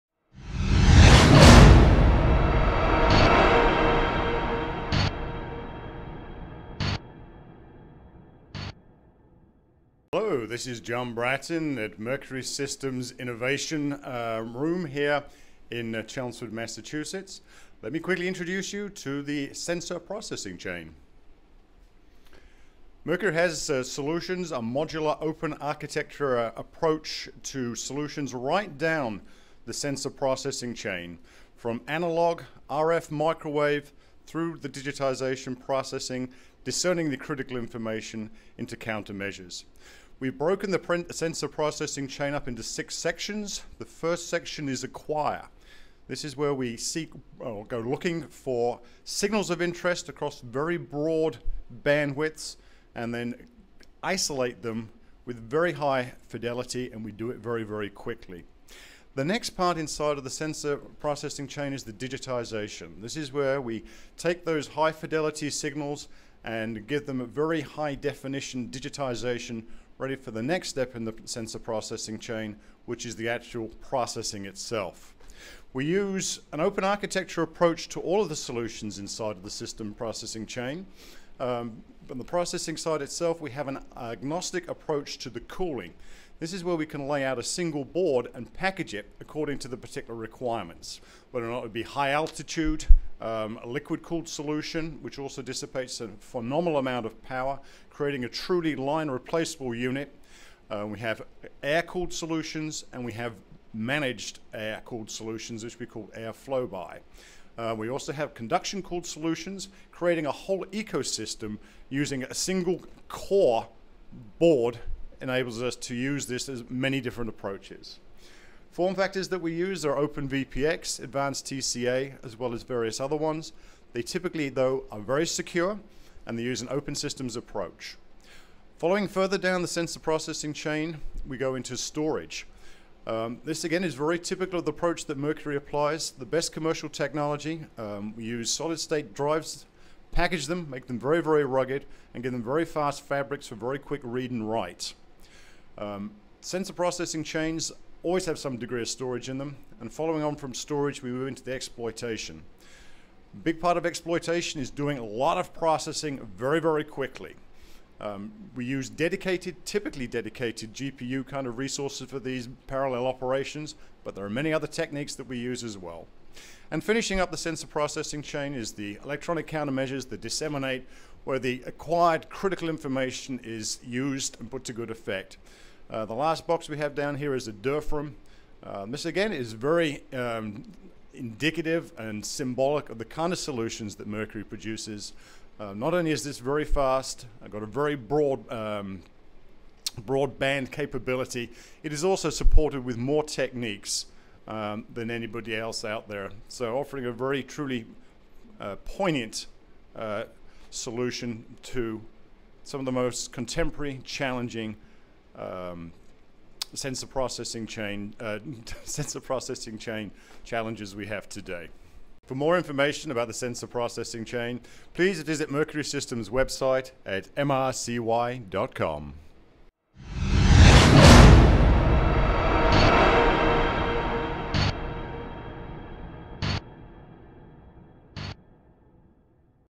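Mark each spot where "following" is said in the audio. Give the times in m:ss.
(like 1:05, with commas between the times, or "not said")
2:08, 2:29.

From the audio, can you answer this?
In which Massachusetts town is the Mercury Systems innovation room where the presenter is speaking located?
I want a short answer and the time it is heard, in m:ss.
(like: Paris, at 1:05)
Chelmsford, at 0:16.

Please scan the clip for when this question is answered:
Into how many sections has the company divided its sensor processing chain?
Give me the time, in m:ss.
0:42.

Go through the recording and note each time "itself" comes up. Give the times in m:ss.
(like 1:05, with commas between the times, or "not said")
1:14, 1:23.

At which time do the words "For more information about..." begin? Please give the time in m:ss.
3:32.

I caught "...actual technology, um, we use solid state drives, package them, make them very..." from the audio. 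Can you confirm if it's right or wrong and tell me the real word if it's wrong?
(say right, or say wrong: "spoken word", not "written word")
wrong: "commercial", not "actual".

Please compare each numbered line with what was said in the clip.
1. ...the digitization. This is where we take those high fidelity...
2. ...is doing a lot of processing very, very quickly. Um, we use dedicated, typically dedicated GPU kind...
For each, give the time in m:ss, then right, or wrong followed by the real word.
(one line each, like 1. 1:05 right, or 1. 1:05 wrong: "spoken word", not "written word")
1. 1:01 right
2. 2:34 right.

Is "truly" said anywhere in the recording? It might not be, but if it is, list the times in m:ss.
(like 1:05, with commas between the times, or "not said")
1:38, 3:17.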